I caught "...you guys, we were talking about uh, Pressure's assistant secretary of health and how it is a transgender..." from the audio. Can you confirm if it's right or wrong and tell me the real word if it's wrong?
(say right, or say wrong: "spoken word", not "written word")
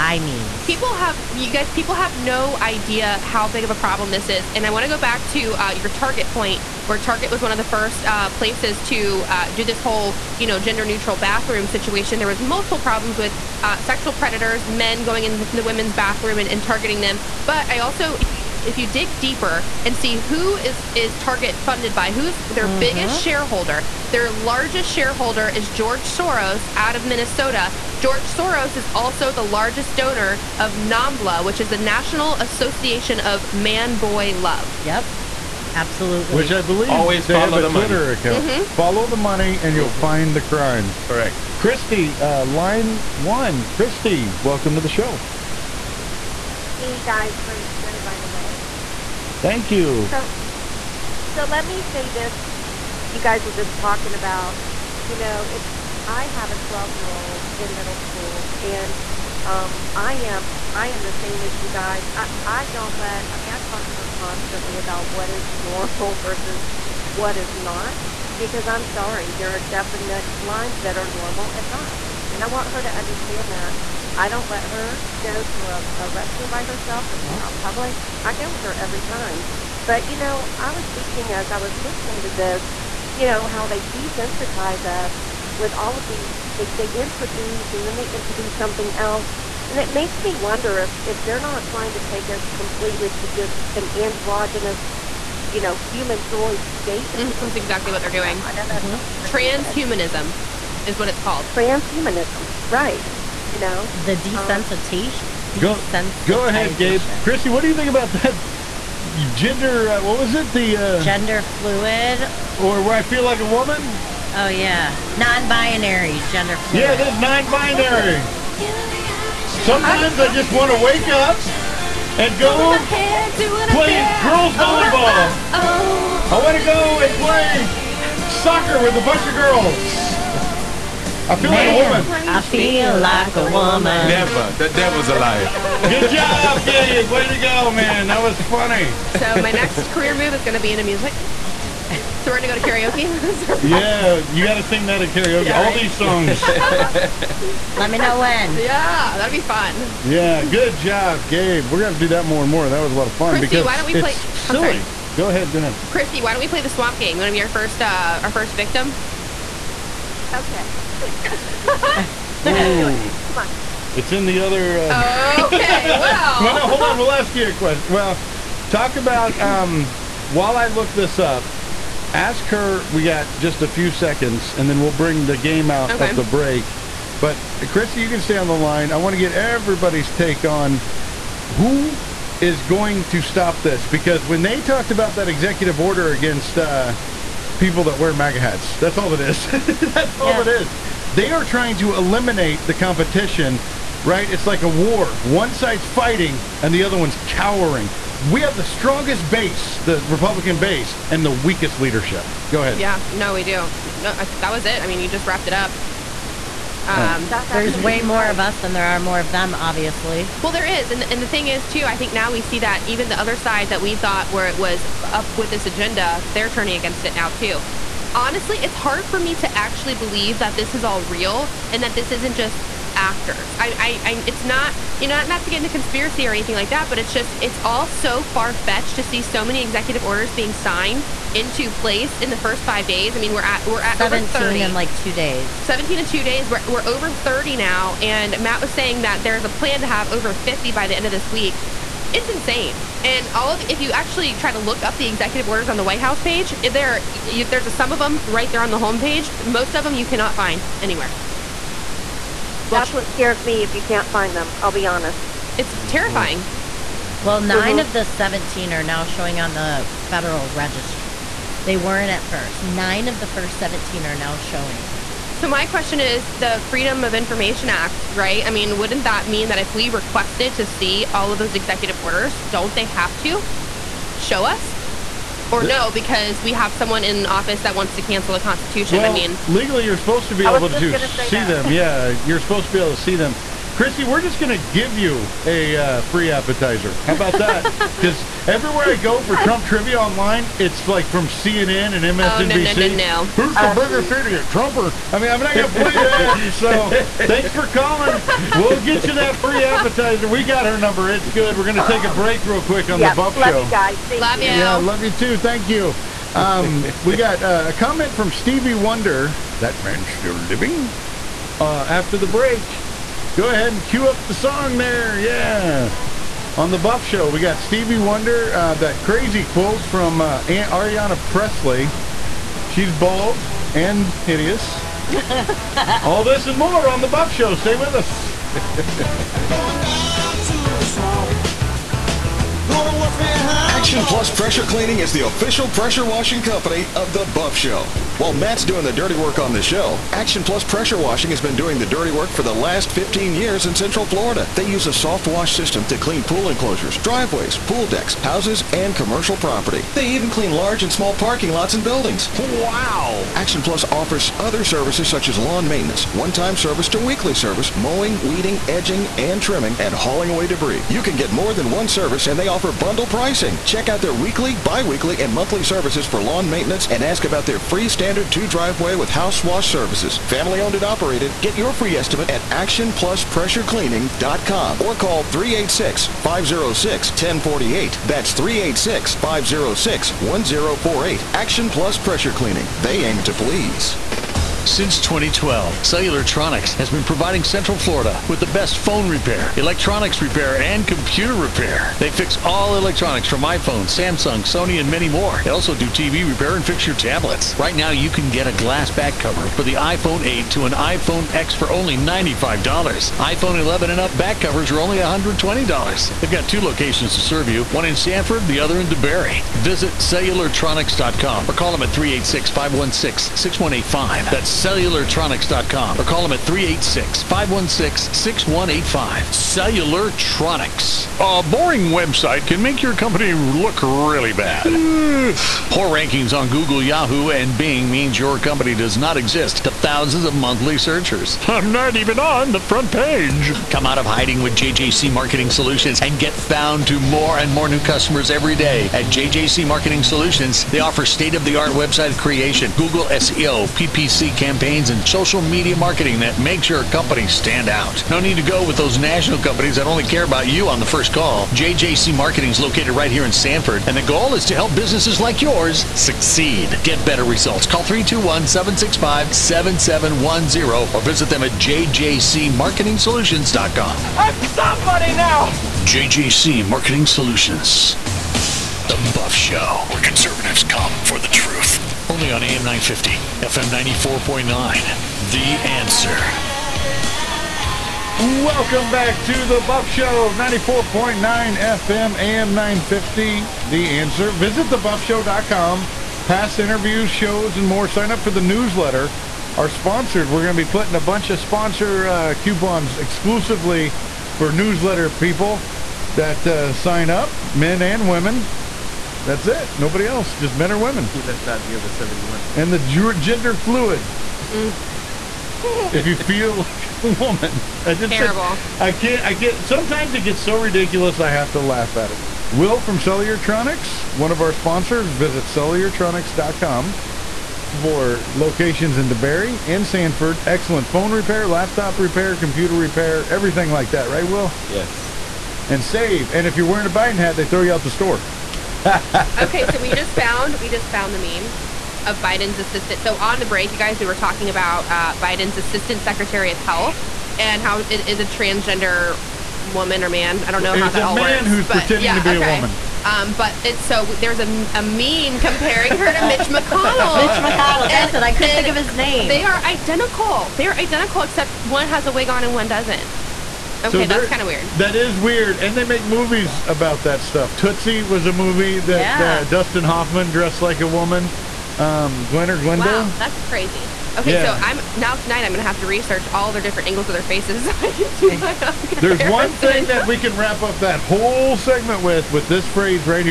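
wrong: "Biden", not "Pressure".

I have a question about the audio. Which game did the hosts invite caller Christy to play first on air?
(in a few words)
the swamp game.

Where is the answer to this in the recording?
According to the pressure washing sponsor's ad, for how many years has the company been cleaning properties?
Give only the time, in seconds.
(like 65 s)
342 s.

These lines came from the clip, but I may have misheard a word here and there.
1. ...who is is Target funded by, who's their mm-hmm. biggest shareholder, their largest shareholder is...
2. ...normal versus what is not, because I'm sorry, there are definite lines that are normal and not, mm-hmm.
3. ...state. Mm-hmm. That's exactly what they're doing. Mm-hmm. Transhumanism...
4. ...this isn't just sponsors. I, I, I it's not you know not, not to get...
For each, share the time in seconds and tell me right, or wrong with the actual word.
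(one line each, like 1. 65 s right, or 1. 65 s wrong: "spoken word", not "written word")
1. 20 s right
2. 65 s right
3. 96 s right
4. 221 s wrong: "actors", not "sponsors".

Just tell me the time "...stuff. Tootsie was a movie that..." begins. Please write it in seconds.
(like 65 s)
557 s.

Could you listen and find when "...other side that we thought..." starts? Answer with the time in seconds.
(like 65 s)
213 s.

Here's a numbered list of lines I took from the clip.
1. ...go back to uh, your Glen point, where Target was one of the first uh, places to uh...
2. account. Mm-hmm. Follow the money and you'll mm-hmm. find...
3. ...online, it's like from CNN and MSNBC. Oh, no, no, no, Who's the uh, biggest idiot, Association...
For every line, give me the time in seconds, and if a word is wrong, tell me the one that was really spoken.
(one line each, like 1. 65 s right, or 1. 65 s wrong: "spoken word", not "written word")
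1. 4 s wrong: "Target", not "Glen"
2. 38 s right
3. 289 s wrong: "Trump", not "Association".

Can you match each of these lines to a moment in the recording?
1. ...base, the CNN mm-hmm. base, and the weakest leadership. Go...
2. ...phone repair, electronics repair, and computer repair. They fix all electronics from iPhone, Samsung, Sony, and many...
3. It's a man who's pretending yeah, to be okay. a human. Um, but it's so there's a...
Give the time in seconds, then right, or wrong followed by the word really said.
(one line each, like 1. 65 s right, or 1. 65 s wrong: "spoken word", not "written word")
1. 199 s wrong: "Republican", not "CNN"
2. 388 s right
3. 541 s wrong: "woman", not "human".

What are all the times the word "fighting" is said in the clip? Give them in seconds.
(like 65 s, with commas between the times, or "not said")
195 s.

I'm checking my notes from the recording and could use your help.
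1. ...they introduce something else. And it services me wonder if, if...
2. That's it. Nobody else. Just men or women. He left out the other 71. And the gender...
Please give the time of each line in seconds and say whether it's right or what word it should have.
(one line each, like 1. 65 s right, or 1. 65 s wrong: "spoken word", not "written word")
1. 87 s wrong: "makes", not "services"
2. 499 s right.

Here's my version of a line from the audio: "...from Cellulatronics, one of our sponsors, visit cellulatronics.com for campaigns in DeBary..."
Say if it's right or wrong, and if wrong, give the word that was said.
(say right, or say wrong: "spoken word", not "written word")
wrong: "locations", not "campaigns".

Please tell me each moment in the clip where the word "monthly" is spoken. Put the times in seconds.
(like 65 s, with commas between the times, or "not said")
365 s, 430 s.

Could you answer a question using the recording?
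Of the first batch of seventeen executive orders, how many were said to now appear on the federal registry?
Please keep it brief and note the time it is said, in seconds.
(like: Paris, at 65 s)
9, at 257 s.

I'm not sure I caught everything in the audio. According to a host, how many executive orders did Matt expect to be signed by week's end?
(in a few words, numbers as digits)
over 50.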